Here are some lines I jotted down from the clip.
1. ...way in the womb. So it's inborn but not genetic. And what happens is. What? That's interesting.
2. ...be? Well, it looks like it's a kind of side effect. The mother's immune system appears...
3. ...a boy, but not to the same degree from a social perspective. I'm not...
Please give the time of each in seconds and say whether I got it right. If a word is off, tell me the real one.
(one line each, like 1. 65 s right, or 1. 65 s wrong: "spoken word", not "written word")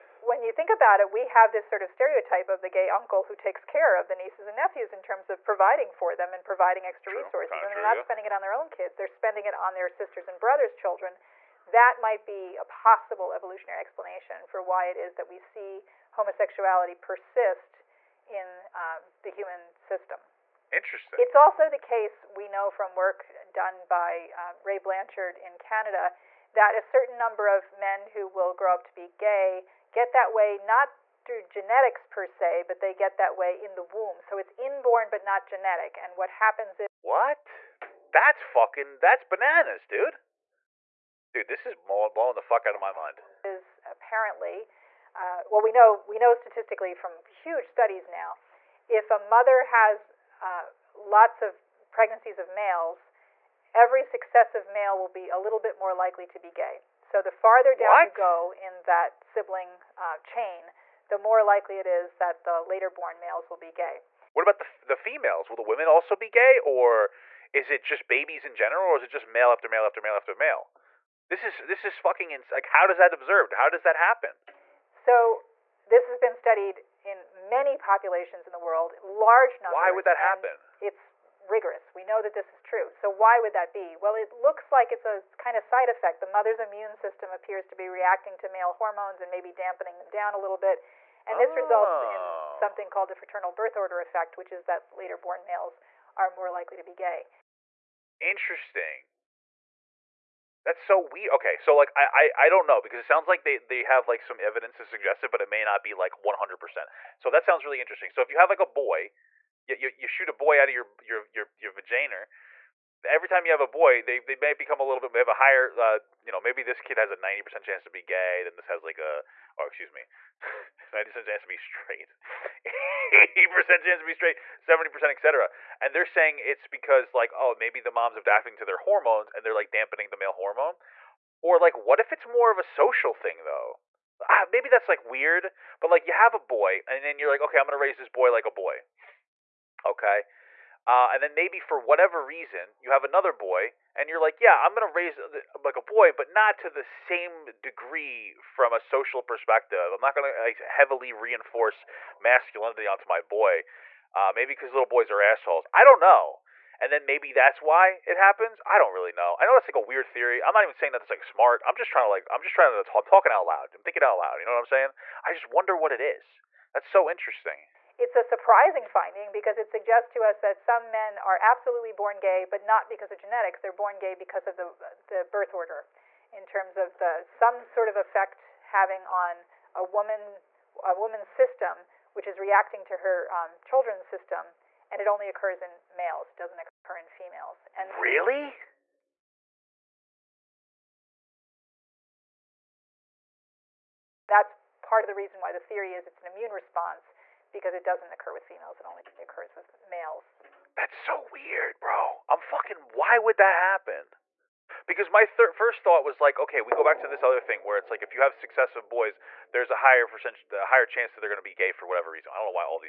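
1. 33 s wrong: "fucking", not "interesting"
2. 83 s right
3. 145 s right.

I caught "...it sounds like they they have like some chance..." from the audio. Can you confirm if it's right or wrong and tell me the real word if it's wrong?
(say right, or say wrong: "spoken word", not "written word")
wrong: "evidence", not "chance".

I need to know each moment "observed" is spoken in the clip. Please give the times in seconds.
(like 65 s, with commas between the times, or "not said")
73 s.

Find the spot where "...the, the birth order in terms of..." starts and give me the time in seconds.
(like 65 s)
174 s.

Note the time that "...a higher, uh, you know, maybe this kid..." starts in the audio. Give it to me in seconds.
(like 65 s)
115 s.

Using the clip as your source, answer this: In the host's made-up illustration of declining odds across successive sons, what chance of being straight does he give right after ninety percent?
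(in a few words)
80%.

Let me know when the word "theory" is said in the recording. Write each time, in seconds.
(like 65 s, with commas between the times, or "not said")
160 s, 195 s.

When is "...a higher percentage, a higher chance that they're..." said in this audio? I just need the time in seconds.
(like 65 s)
209 s.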